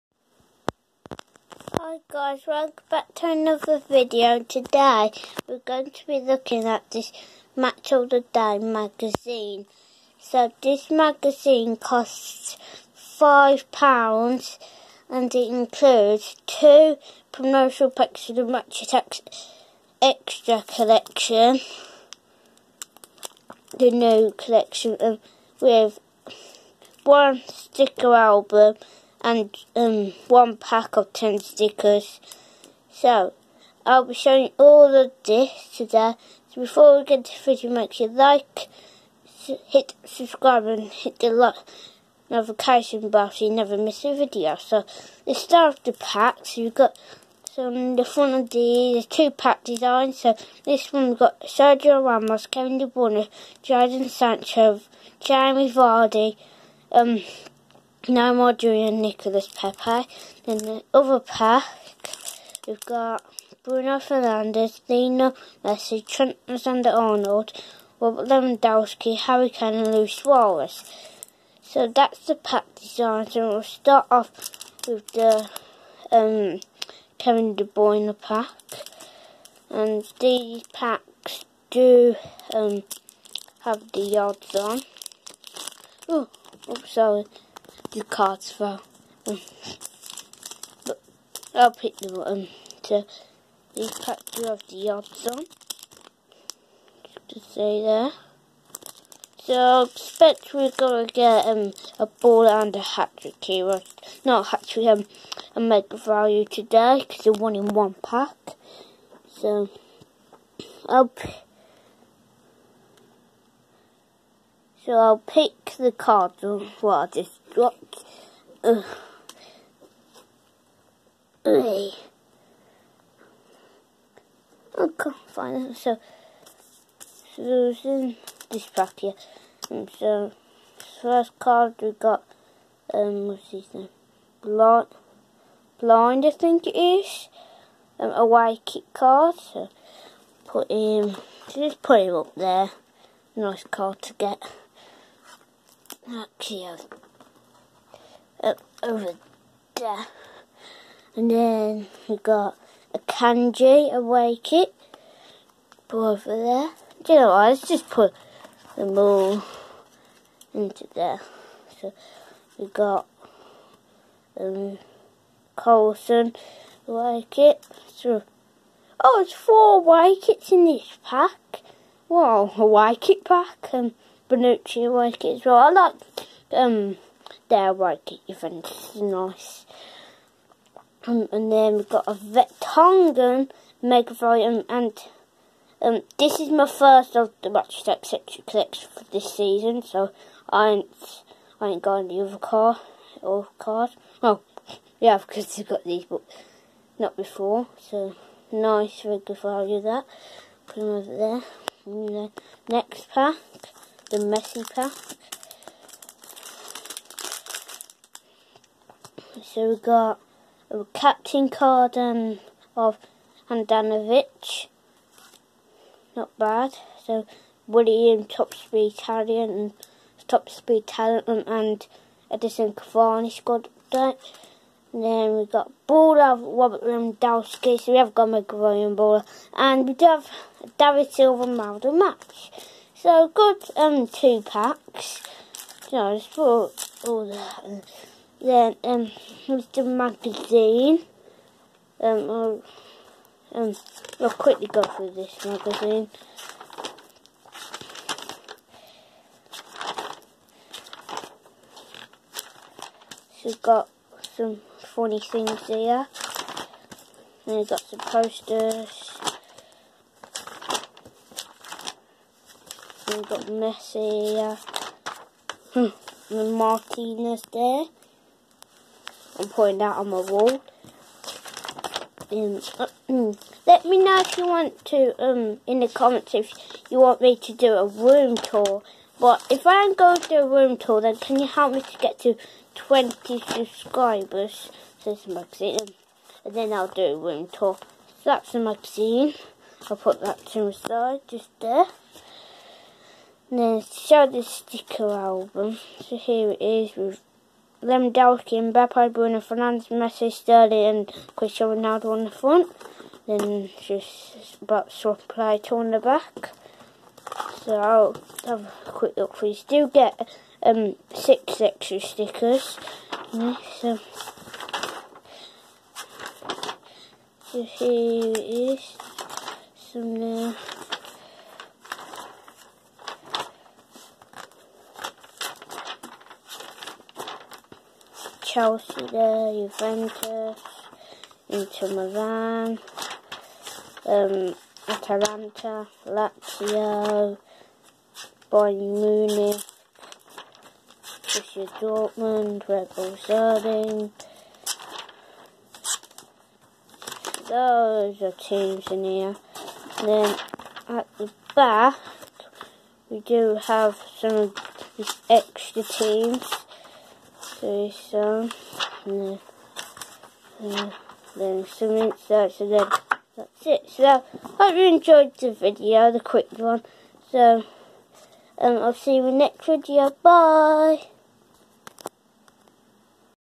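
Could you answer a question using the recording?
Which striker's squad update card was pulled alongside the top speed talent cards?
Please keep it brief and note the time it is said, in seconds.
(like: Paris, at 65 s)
Edinson Cavani, at 222 s.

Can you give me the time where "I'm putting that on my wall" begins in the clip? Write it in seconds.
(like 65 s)
269 s.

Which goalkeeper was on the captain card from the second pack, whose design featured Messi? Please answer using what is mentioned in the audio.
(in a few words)
Handanovic.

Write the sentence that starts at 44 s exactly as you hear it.
So, let's start with the packs.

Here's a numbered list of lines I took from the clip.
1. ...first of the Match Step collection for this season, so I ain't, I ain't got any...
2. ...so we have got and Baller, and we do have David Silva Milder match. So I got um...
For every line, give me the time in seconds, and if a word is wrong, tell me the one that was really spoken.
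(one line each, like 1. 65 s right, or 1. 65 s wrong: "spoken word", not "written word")
1. 186 s right
2. 227 s right.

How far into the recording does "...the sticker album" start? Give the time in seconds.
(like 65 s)
294 s.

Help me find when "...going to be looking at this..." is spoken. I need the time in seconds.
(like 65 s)
5 s.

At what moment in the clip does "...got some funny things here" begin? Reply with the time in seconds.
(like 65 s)
253 s.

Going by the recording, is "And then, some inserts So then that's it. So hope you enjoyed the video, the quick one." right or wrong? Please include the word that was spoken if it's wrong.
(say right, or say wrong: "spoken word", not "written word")
right.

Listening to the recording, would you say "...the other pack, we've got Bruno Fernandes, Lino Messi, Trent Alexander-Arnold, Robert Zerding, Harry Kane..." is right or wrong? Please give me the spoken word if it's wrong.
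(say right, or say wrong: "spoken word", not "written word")
wrong: "Lewandowski", not "Zerding".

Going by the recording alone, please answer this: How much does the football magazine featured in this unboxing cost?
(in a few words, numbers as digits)
£5.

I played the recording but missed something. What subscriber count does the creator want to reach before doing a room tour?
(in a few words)
20.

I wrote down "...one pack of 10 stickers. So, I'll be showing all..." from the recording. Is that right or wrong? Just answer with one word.
right.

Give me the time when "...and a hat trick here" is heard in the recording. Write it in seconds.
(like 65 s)
102 s.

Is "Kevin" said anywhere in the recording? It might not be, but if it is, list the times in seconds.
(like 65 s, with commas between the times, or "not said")
52 s, 77 s.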